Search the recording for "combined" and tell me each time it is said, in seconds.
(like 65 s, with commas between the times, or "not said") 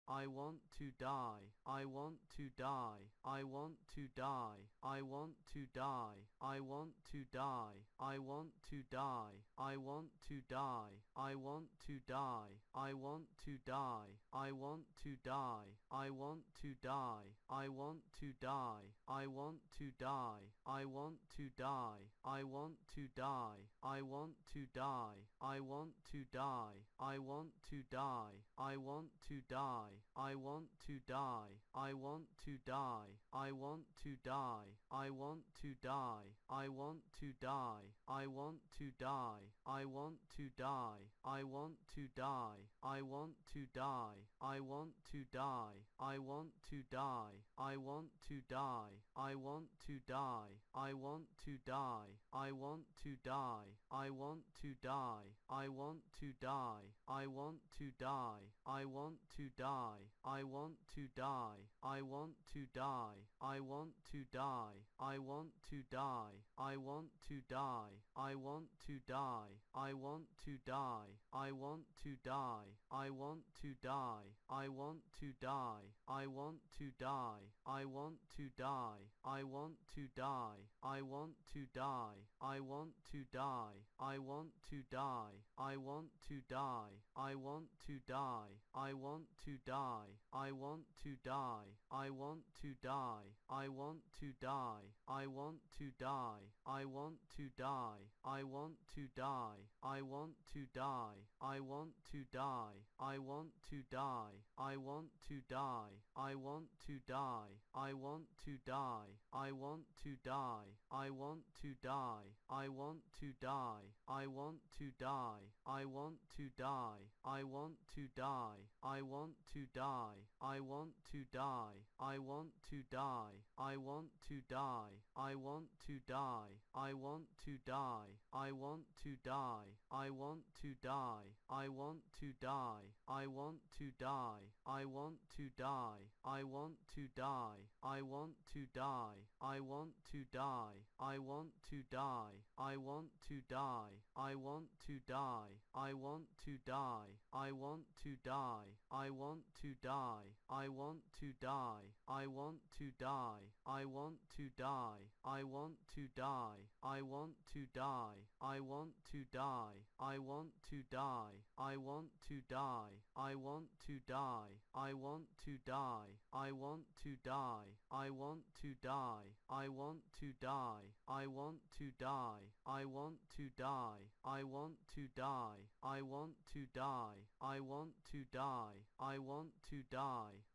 not said.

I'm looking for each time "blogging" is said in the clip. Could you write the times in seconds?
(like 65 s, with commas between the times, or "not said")
not said.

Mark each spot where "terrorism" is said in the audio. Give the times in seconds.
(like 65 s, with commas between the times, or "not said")
not said.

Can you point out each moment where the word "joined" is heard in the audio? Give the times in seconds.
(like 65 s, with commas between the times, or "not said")
not said.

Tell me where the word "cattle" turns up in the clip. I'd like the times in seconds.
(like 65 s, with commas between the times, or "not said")
not said.